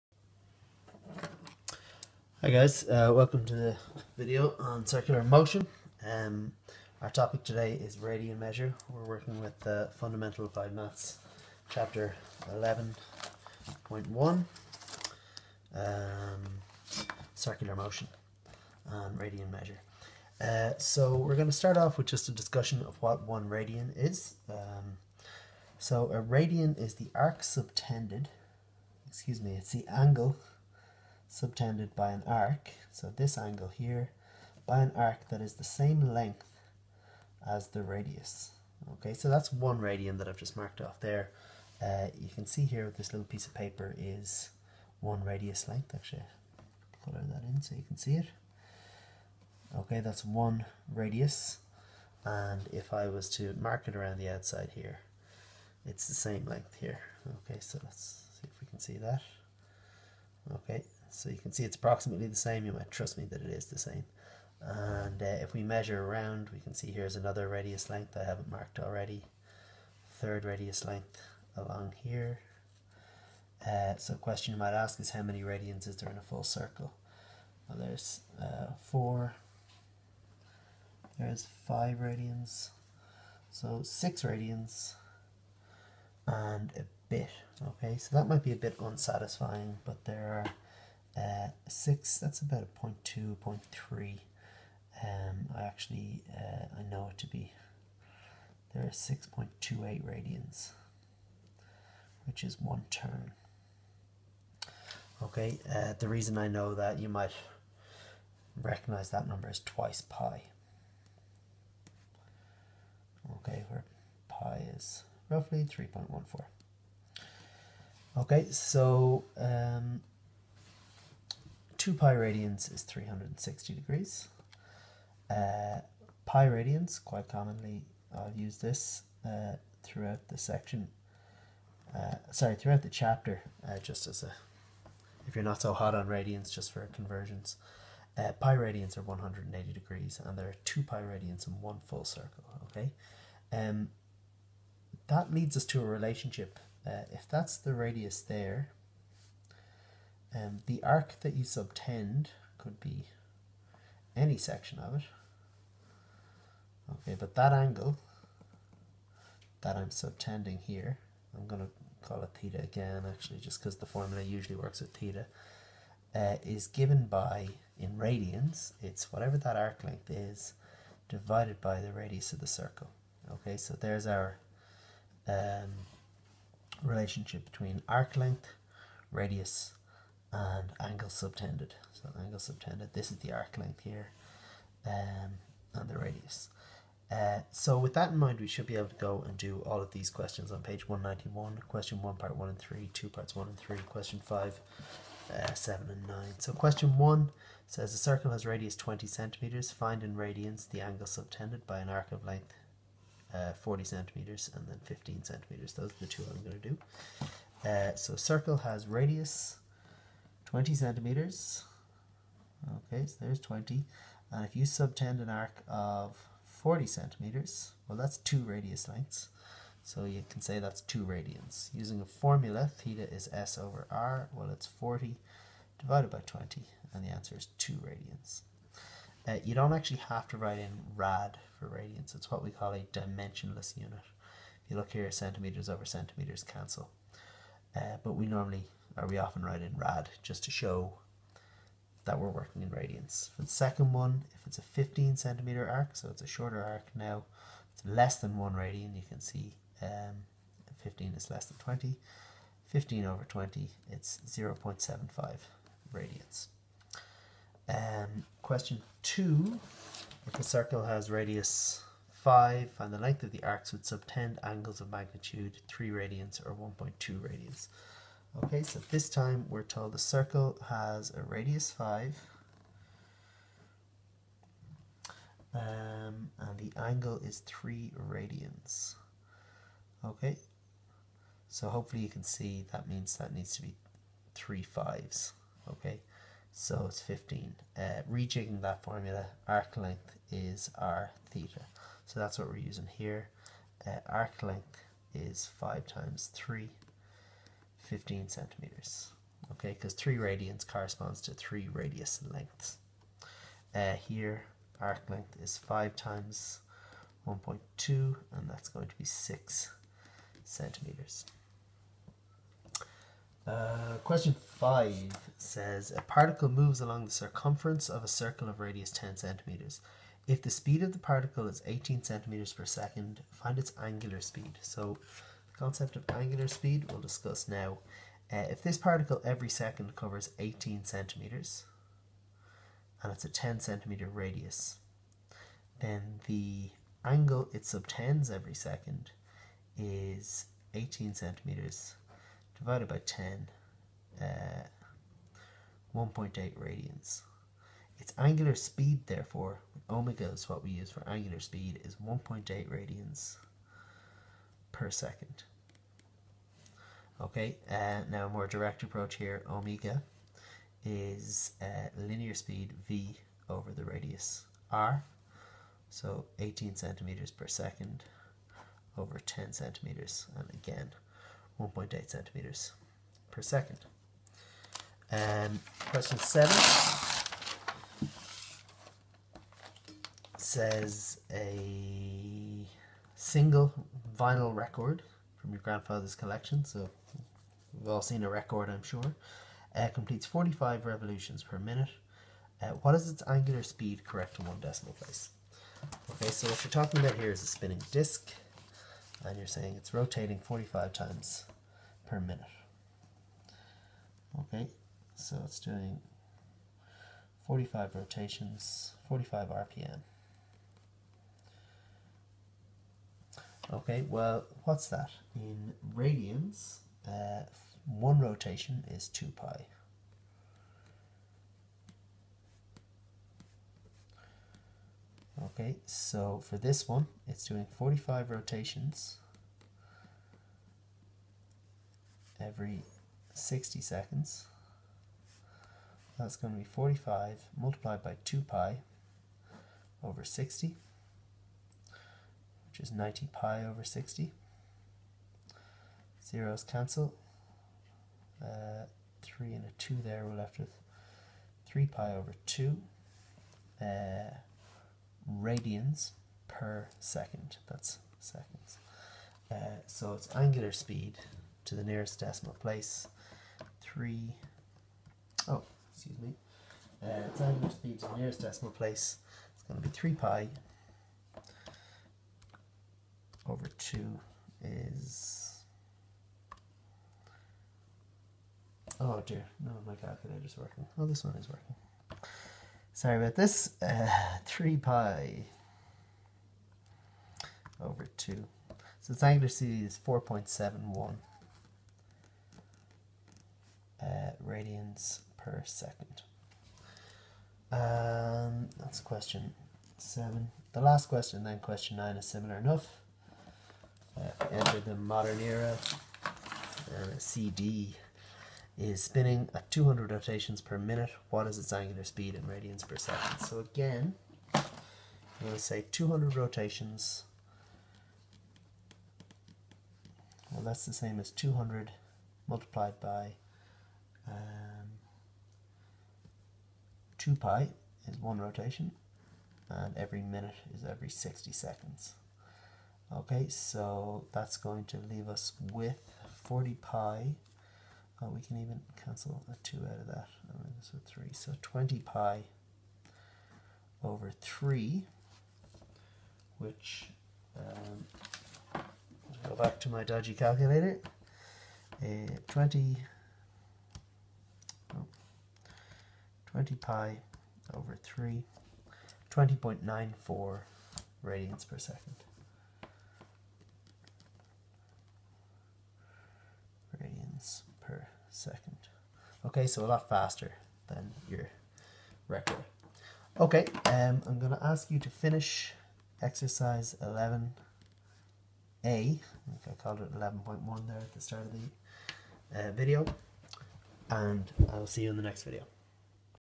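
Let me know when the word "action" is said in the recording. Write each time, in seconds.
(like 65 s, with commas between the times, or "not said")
not said.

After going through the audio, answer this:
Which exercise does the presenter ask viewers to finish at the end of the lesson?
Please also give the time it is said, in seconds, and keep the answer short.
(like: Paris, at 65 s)
11A, at 576 s.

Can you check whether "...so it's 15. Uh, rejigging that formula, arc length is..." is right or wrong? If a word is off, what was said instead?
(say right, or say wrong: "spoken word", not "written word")
right.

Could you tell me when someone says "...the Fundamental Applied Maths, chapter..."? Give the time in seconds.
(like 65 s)
9 s.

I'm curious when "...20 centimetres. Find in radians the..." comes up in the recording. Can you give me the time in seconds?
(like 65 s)
198 s.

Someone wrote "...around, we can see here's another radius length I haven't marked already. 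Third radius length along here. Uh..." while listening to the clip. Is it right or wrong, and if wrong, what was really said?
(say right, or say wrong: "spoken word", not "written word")
right.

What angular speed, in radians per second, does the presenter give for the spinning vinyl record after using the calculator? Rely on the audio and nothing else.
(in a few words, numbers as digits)
4.71.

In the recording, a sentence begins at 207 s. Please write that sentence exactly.
Uh, so circle has radius 20 centimeters.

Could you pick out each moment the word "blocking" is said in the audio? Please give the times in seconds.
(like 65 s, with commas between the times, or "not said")
not said.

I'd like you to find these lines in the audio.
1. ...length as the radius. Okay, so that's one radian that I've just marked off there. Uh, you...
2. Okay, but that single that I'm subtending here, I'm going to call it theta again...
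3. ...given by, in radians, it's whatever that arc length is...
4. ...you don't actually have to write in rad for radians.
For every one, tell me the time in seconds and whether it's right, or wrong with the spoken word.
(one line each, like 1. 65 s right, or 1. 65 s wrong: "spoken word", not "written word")
1. 36 s right
2. 156 s wrong: "angle", not "single"
3. 166 s right
4. 229 s right.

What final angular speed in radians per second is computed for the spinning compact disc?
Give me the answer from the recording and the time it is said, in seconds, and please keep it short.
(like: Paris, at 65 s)
20.94, at 559 s.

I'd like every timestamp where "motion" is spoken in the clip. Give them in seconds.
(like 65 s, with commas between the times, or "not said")
5 s, 17 s.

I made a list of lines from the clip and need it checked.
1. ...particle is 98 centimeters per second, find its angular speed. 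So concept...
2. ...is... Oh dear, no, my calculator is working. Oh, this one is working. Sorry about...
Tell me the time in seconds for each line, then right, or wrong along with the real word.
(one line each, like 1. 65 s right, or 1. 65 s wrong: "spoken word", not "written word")
1. 320 s wrong: "18", not "98"
2. 474 s right.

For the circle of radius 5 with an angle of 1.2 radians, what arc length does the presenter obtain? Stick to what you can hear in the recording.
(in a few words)
6 centimeters.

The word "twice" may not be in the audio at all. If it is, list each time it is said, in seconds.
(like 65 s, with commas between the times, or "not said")
109 s.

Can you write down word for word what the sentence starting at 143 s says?
Um, that leads us to a relationship.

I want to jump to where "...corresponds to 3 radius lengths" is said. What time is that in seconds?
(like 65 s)
300 s.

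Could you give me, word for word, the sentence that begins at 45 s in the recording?
Actually, color that in so you can see it.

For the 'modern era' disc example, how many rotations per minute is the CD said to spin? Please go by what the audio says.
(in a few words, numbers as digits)
200.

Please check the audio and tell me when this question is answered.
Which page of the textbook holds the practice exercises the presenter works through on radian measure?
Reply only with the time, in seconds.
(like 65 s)
190 s.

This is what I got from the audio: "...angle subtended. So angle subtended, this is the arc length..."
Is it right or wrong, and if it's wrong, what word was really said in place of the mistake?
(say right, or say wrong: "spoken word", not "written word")
right.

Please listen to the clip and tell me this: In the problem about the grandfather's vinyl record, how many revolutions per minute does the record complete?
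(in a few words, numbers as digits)
45.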